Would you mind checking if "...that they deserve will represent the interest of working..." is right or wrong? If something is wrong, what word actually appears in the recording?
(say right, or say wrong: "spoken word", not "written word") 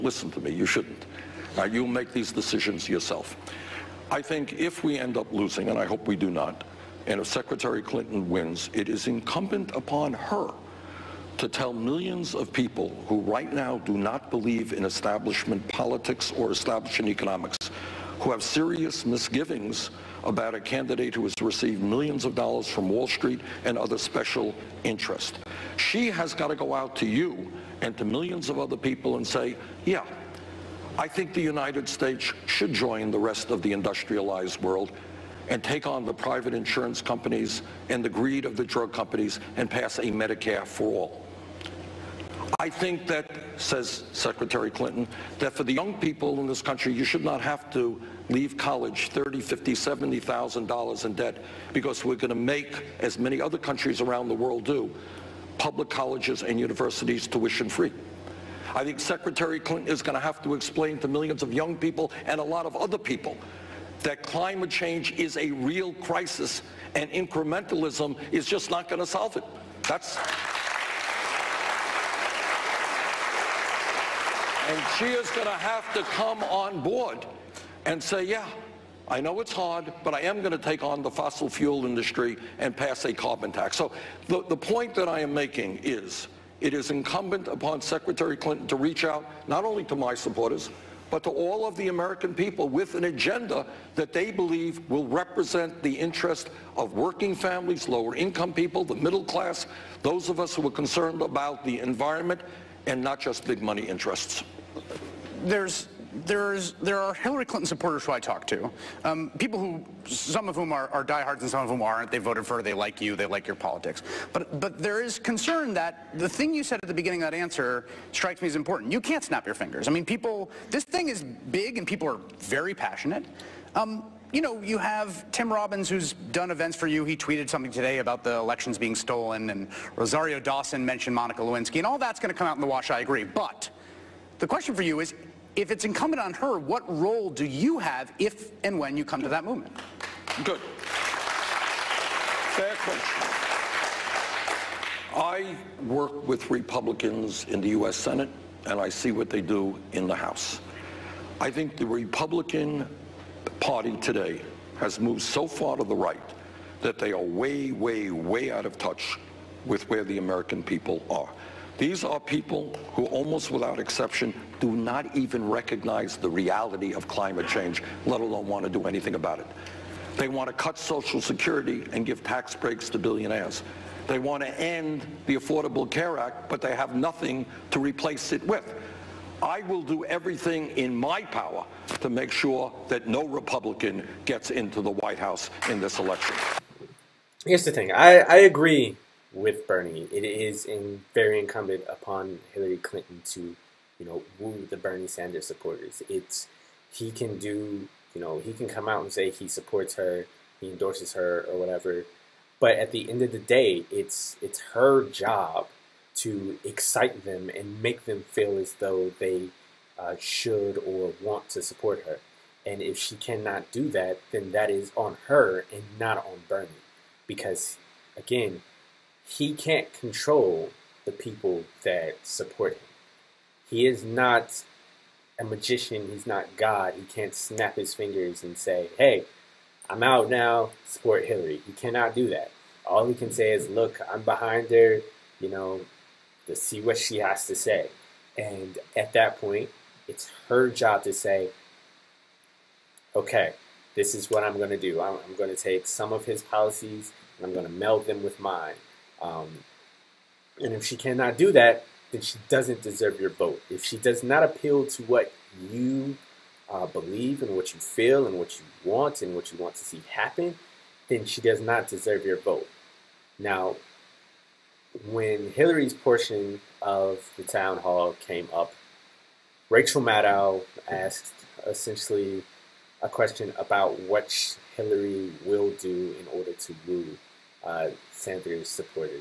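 wrong: "believe", not "deserve".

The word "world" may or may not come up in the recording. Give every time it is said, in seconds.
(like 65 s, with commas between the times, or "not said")
34 s, 54 s.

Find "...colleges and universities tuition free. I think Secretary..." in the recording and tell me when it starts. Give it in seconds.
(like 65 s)
55 s.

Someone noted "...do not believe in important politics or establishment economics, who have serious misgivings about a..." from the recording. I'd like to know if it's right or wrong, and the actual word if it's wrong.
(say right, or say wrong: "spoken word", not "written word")
wrong: "establishment", not "important".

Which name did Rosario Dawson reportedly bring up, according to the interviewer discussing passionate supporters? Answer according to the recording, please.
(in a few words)
Monica Lewinsky.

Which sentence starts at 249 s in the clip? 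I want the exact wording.
Um, and if she cannot do that, then she doesn't deserve your vote.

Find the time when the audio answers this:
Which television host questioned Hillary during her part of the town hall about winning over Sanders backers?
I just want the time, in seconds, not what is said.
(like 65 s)
269 s.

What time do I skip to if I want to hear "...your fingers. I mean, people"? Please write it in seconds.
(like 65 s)
119 s.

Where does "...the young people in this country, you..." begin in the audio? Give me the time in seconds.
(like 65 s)
45 s.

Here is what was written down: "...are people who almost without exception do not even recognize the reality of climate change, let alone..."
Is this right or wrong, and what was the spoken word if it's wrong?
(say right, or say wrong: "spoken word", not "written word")
right.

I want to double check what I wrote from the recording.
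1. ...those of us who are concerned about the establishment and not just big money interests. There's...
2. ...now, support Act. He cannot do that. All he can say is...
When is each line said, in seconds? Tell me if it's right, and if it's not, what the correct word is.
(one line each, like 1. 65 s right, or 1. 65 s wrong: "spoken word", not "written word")
1. 100 s wrong: "environment", not "establishment"
2. 230 s wrong: "Hillary", not "Act".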